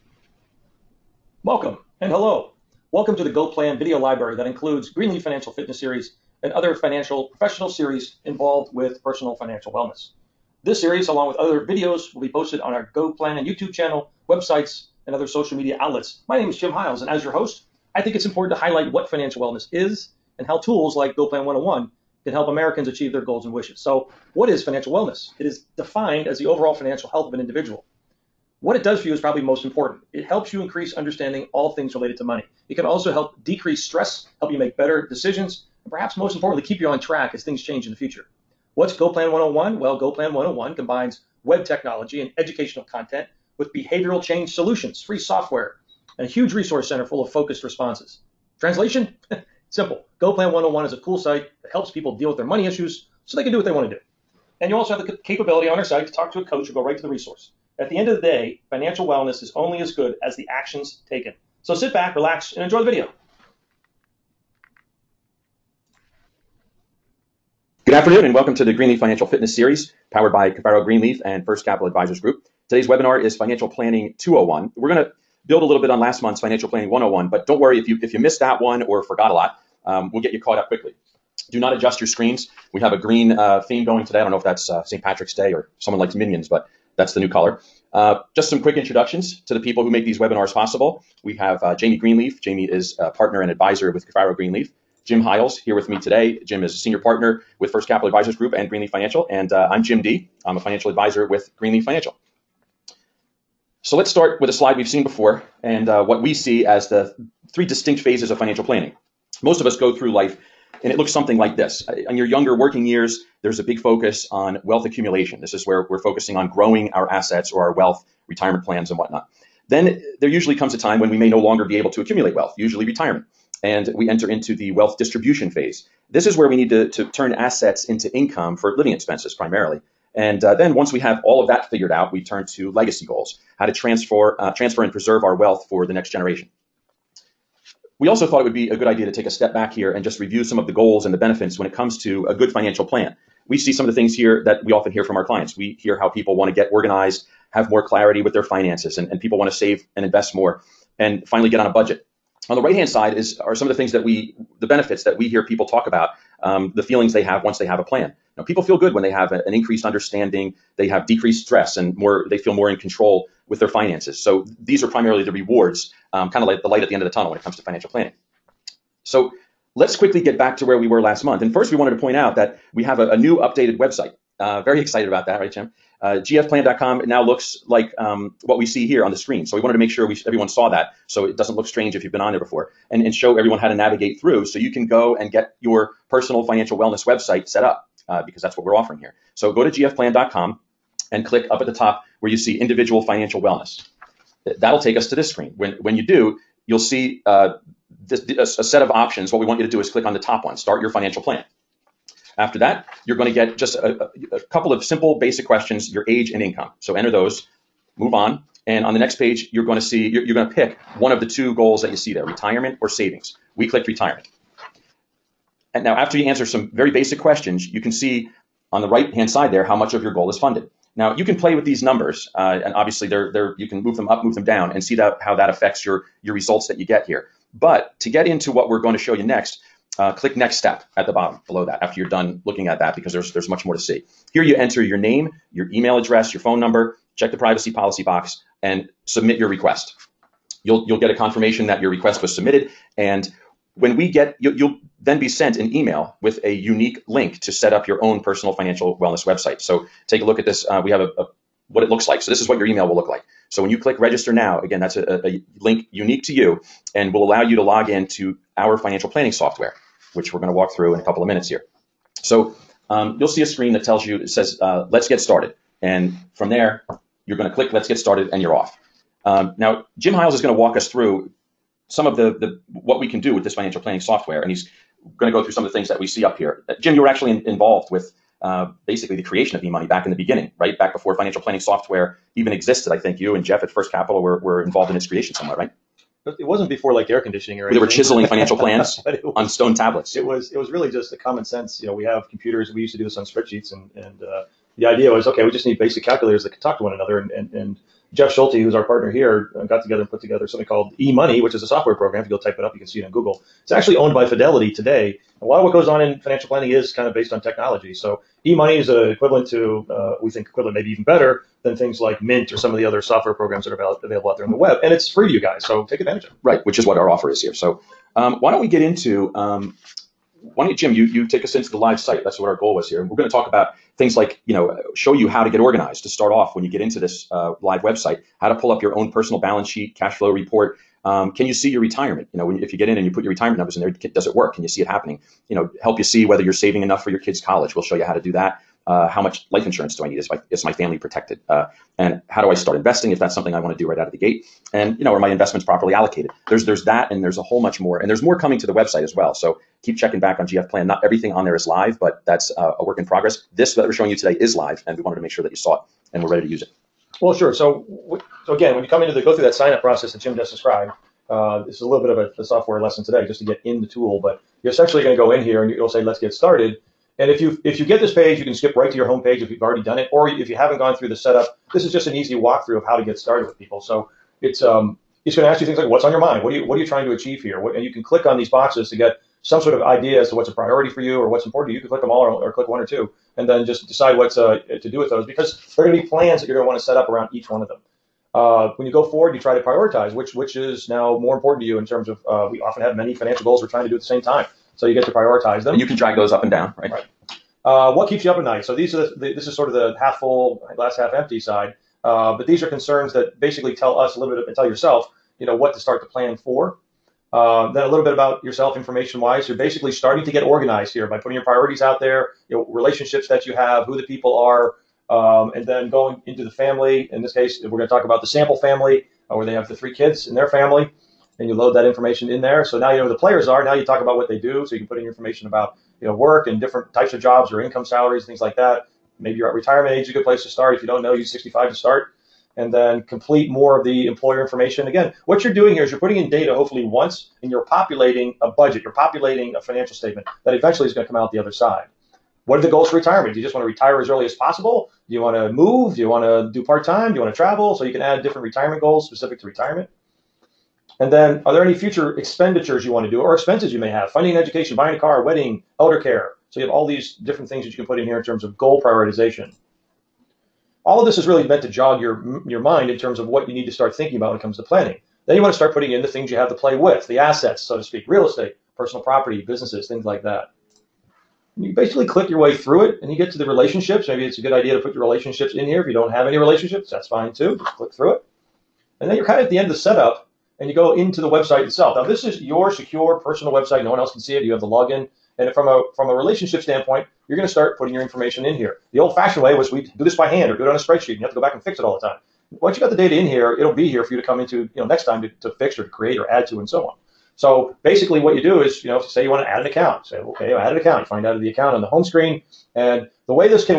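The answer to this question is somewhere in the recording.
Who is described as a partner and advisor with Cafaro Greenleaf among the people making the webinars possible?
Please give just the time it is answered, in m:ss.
1:31.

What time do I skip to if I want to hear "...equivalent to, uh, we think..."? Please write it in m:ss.
5:09.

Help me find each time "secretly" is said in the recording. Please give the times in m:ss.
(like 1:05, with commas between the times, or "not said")
not said.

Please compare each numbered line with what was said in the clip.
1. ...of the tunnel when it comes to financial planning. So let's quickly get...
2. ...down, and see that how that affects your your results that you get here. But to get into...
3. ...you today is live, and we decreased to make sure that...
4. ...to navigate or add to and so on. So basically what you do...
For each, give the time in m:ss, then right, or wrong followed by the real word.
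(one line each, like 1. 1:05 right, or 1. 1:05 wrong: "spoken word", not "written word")
1. 2:47 right
2. 3:44 right
3. 5:54 wrong: "wanted", not "decreased"
4. 8:15 wrong: "create", not "navigate".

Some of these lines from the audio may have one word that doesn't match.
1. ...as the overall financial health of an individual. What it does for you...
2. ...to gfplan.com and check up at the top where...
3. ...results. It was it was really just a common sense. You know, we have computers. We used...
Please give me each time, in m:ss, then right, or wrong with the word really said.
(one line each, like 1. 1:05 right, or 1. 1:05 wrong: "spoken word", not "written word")
1. 0:26 right
2. 3:09 wrong: "click", not "check"
3. 4:49 wrong: "tablets", not "results".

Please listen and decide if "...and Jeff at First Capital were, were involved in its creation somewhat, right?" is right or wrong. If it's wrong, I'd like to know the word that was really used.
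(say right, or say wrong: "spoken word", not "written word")
right.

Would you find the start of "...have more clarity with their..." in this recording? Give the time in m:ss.
2:27.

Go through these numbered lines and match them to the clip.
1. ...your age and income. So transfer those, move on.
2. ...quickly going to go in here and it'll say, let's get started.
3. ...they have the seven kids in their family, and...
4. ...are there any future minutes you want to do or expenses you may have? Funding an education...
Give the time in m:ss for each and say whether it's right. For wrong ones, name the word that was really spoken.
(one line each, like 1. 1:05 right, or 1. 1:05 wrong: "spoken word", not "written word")
1. 3:25 wrong: "enter", not "transfer"
2. 6:04 wrong: "essentially", not "quickly"
3. 6:59 wrong: "three", not "seven"
4. 7:31 wrong: "expenditures", not "minutes".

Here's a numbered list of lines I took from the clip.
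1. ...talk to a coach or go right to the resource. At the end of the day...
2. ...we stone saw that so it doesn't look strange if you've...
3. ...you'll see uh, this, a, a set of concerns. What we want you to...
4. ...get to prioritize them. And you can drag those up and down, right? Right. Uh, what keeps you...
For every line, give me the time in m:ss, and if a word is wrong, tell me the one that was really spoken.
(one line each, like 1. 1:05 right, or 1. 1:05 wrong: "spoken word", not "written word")
1. 0:56 right
2. 3:00 wrong: "everyone", not "stone"
3. 3:16 wrong: "options", not "concerns"
4. 6:34 right.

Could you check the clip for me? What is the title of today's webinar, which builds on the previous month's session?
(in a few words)
Financial Planning 201.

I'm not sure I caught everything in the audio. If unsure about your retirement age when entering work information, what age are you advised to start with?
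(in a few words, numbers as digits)
65.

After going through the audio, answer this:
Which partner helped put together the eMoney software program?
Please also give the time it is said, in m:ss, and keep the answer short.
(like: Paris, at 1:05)
Jeff Schulte, at 4:58.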